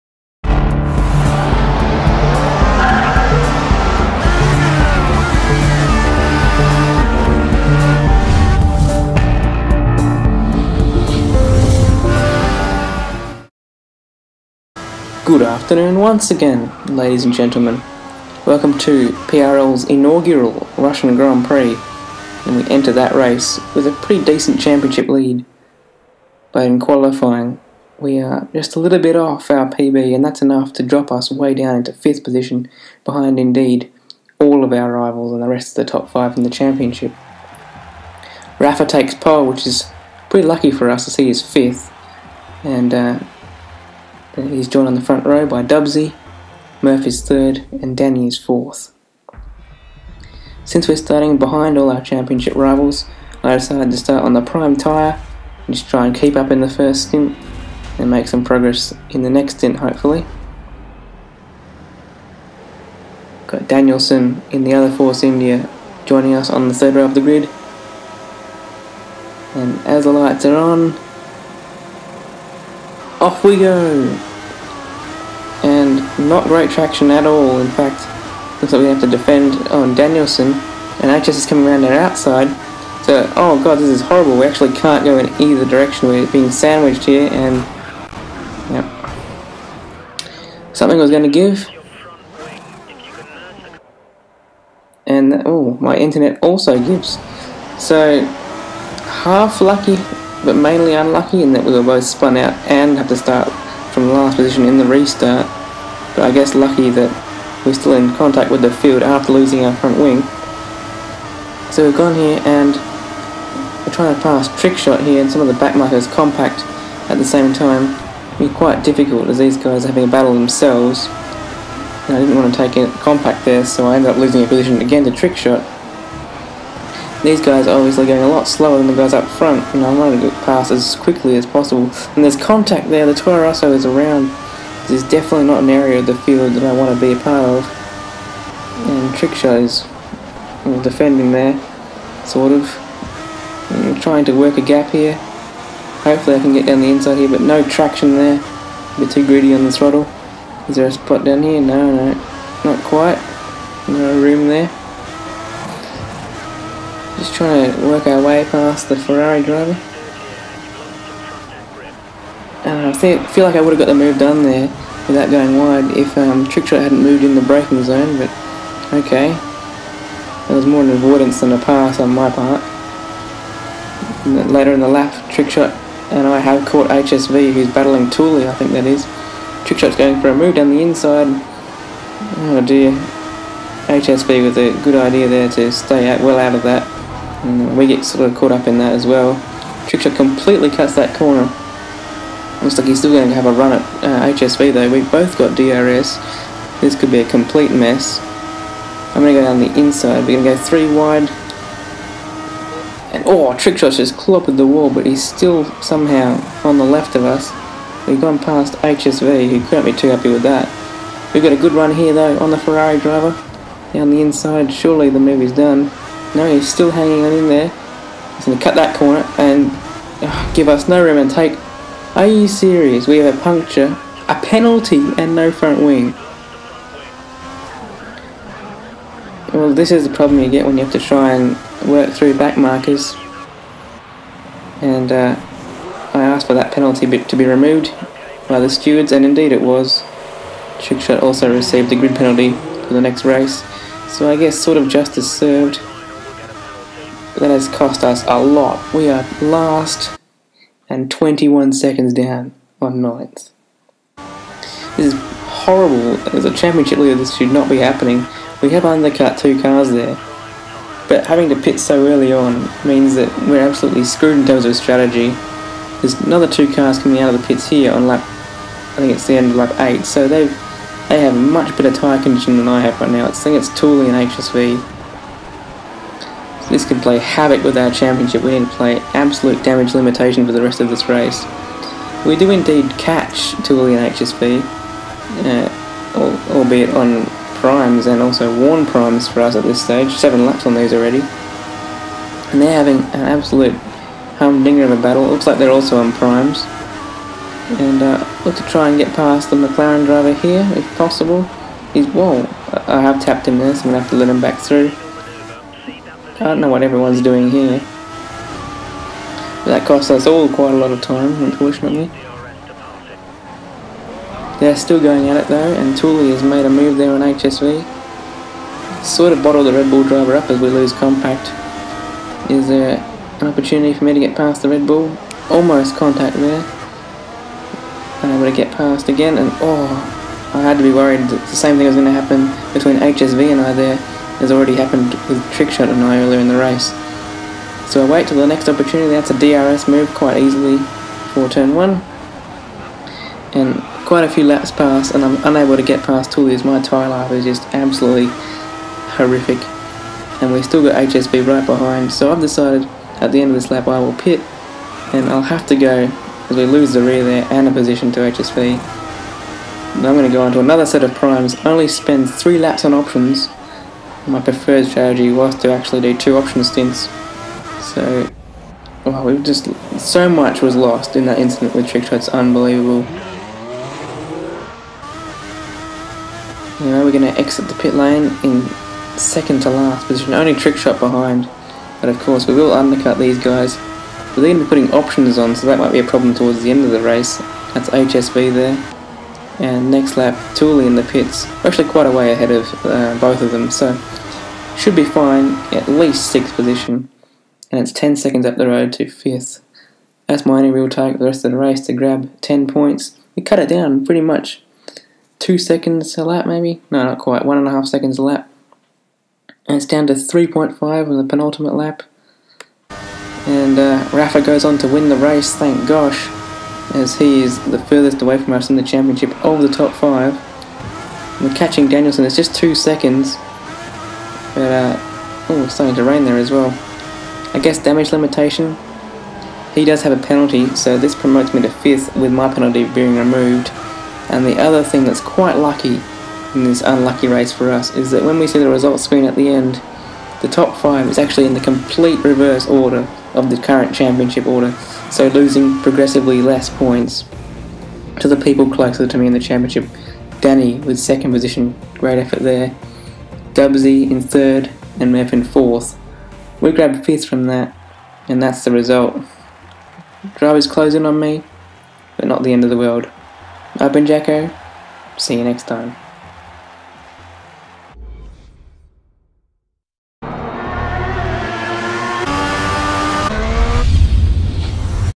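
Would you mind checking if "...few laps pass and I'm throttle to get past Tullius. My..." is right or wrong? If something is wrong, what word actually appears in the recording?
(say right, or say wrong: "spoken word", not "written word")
wrong: "unable", not "throttle".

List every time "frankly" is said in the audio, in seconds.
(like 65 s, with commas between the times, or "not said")
not said.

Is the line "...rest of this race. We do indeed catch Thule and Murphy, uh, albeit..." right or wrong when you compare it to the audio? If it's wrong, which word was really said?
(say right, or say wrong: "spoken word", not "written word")
wrong: "HSV", not "Murphy".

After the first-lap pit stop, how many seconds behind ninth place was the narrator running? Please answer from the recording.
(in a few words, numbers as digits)
21.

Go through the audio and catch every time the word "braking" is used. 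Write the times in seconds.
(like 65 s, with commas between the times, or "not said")
167 s.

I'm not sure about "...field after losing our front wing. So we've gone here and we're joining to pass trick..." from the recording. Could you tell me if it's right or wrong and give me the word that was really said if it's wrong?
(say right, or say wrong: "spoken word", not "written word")
wrong: "trying", not "joining".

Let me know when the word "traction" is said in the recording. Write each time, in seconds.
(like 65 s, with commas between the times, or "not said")
76 s, 147 s.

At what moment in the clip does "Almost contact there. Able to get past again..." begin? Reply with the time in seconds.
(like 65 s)
325 s.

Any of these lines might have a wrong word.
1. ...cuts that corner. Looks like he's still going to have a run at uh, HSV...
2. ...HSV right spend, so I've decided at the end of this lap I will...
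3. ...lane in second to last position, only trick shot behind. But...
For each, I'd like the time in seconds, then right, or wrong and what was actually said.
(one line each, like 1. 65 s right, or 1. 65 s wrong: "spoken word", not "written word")
1. 190 s right
2. 350 s wrong: "behind", not "spend"
3. 377 s right.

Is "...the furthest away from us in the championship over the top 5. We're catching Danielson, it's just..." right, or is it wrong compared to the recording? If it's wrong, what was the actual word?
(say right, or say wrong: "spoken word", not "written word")
right.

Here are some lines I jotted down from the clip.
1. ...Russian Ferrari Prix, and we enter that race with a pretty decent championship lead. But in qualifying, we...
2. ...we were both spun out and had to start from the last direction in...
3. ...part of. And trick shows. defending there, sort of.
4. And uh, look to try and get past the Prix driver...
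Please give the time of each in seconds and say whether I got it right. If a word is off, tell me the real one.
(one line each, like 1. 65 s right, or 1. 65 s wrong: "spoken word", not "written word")
1. 20 s wrong: "Grand", not "Ferrari"
2. 101 s wrong: "position", not "direction"
3. 137 s right
4. 297 s wrong: "McLaren", not "Prix".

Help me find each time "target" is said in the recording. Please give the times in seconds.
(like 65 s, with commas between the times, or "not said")
400 s.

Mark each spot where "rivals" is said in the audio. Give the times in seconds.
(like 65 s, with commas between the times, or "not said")
34 s, 52 s.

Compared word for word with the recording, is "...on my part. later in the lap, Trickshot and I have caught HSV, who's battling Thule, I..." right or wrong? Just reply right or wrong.
right.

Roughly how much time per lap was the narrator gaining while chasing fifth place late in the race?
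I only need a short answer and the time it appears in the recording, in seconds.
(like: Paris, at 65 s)
1.5 seconds, at 407 s.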